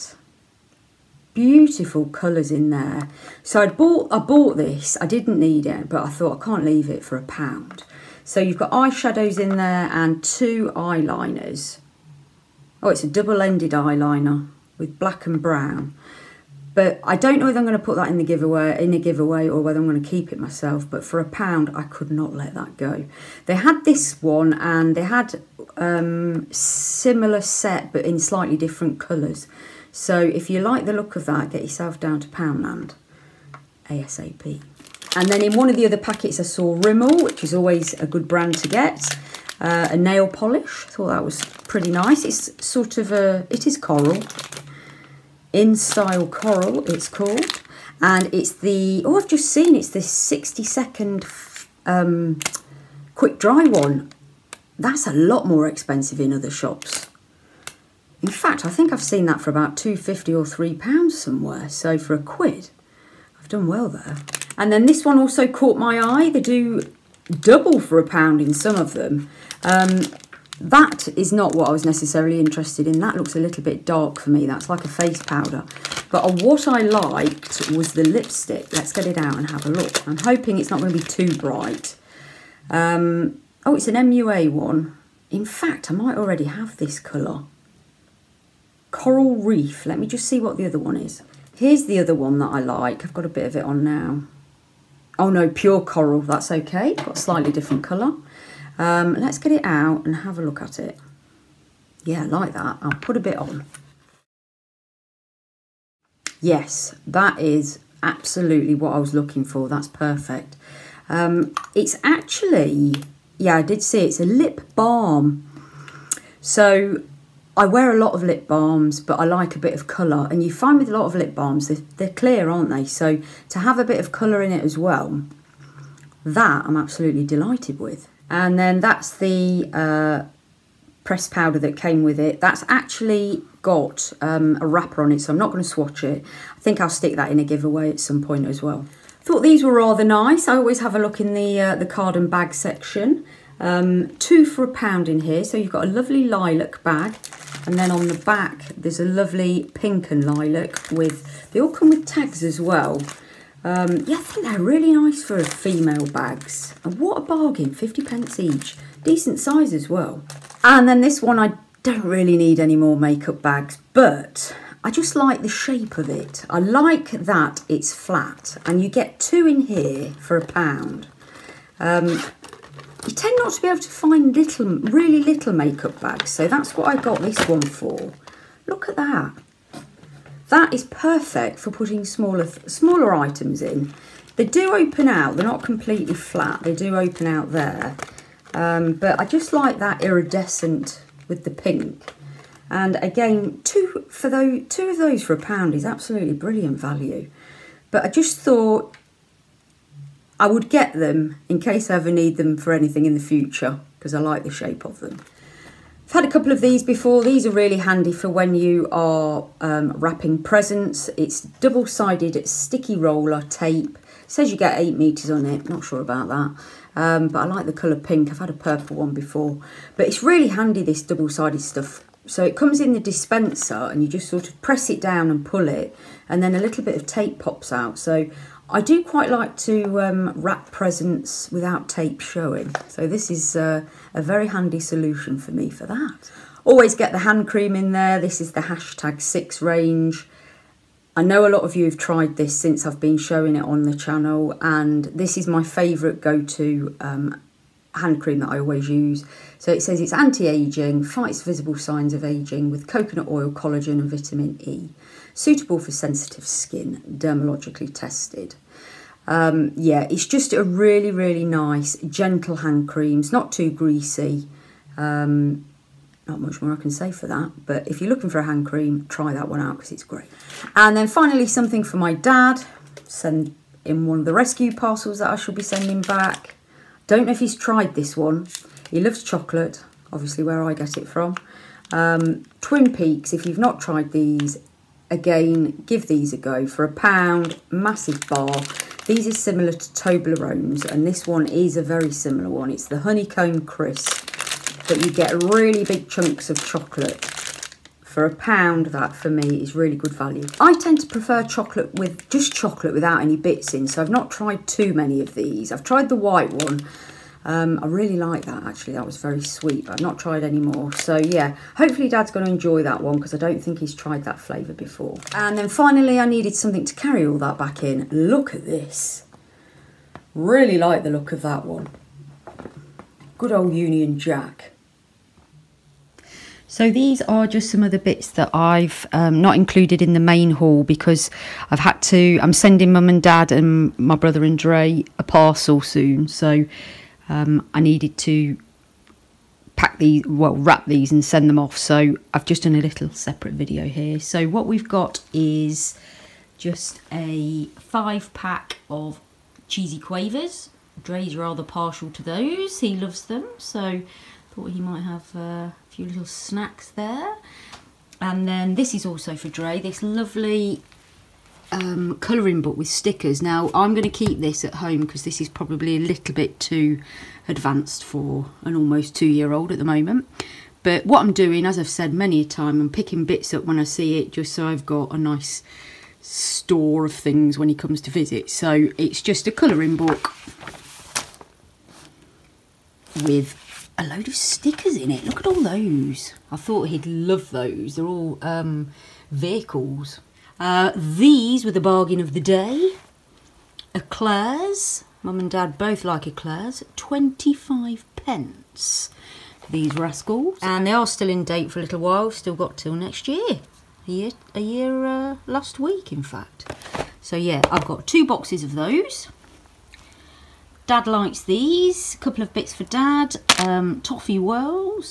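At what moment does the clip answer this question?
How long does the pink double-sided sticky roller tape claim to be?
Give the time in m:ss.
3:34.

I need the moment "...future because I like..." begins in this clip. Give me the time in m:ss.
3:23.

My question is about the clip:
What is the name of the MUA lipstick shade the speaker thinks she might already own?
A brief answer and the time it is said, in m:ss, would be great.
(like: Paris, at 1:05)
Coral Reef, at 1:28.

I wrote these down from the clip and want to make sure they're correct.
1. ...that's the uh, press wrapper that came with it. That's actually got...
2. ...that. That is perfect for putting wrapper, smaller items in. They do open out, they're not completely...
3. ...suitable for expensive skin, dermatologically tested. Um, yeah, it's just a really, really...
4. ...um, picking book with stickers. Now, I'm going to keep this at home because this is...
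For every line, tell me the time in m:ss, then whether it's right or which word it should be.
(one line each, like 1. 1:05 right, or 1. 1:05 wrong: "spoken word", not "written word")
1. 2:08 wrong: "powder", not "wrapper"
2. 2:58 wrong: "smaller", not "wrapper"
3. 4:15 wrong: "sensitive", not "expensive"
4. 6:01 wrong: "colouring", not "picking".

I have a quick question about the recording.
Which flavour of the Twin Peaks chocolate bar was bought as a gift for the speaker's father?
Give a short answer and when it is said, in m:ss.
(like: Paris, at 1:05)
Honeycomb Crisp, at 4:52.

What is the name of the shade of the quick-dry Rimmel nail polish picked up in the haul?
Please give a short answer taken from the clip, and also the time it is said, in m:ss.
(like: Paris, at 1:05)
Style Coral, at 0:45.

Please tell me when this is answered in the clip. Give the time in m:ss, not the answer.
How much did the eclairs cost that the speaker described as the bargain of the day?
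6:36.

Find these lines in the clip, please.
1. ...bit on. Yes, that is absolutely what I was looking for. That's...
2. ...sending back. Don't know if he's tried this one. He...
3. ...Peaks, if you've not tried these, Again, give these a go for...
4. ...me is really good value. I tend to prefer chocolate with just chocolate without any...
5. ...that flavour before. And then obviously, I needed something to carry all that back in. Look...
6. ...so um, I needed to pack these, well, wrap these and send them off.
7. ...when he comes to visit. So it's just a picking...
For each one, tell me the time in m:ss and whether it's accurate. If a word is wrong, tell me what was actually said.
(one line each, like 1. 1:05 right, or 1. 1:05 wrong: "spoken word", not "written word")
1. 1:43 right
2. 4:35 right
3. 4:42 right
4. 4:59 right
5. 5:14 wrong: "finally", not "obviously"
6. 5:36 right
7. 6:17 wrong: "colouring", not "picking".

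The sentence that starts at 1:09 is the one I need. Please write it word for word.
Um, that is not what I was necessarily interested in.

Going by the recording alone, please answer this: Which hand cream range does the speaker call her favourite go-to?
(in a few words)
hashtag 6.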